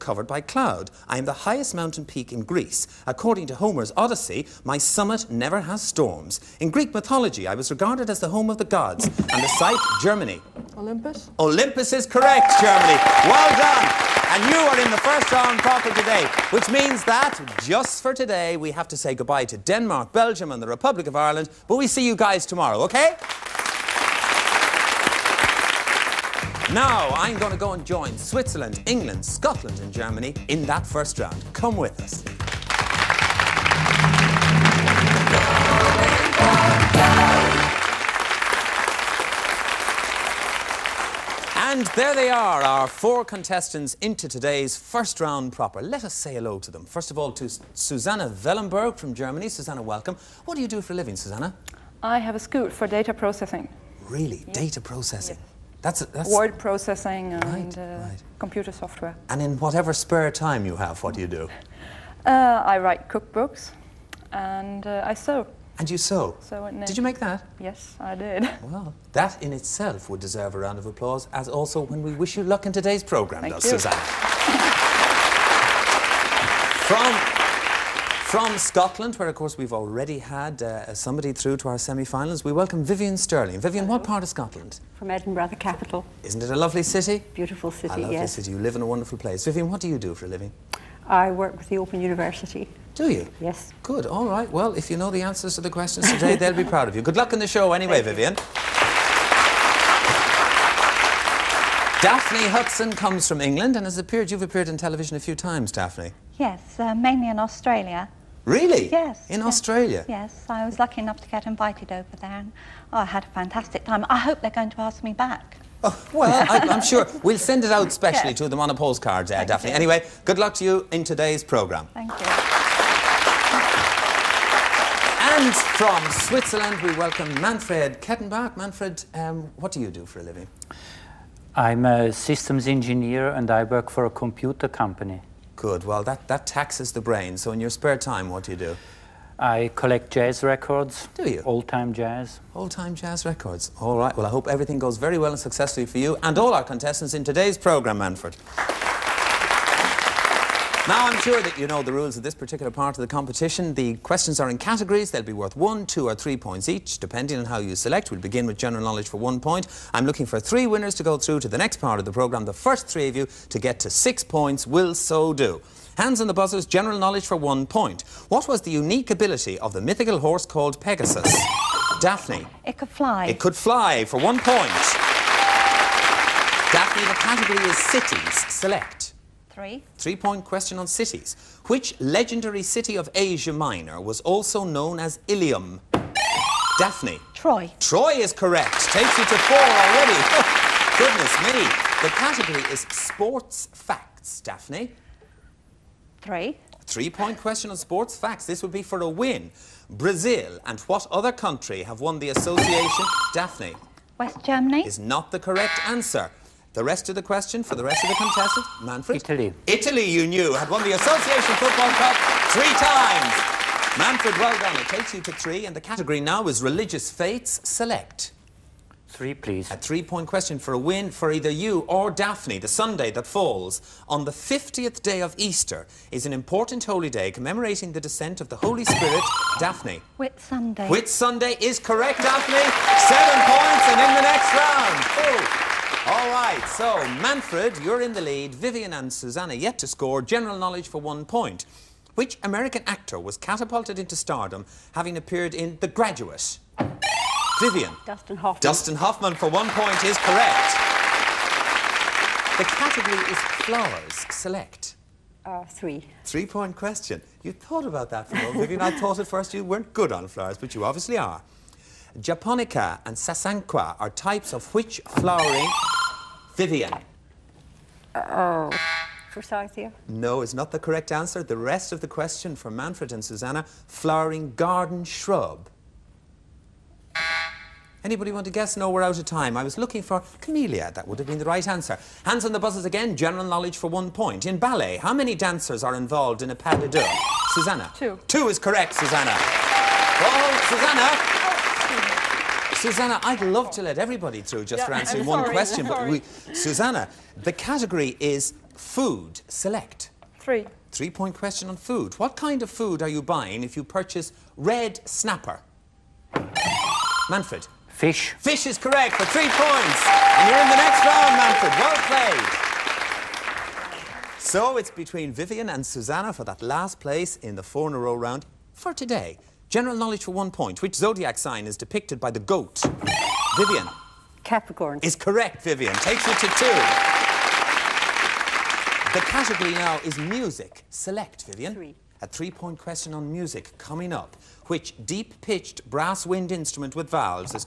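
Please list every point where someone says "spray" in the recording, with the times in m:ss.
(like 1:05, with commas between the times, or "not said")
not said.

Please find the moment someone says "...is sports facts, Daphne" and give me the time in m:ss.
3:12.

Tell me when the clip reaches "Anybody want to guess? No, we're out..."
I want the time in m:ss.
4:38.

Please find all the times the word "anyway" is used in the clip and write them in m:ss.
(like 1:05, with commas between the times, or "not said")
1:37, 1:59.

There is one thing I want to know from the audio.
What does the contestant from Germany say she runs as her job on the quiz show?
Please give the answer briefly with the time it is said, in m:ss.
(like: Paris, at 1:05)
A school for data processing, at 0:52.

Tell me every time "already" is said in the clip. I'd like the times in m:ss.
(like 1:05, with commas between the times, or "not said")
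1:19, 3:09.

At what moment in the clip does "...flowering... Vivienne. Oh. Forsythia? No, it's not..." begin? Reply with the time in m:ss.
4:25.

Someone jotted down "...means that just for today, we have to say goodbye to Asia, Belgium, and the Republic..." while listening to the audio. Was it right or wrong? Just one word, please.
wrong.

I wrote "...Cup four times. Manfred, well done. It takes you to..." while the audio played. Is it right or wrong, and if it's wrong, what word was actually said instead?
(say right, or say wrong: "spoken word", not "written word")
wrong: "three", not "four".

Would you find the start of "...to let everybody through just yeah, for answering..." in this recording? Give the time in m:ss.
4:53.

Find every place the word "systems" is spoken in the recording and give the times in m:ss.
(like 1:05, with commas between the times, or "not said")
2:12.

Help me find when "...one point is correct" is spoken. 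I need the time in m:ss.
4:09.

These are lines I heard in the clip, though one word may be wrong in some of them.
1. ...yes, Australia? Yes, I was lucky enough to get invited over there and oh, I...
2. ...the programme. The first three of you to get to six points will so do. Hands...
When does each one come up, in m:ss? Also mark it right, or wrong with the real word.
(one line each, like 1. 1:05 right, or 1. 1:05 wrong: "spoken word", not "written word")
1. 1:49 right
2. 2:42 right.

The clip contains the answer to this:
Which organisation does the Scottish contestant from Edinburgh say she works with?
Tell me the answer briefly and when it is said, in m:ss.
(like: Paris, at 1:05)
The Open University, at 1:31.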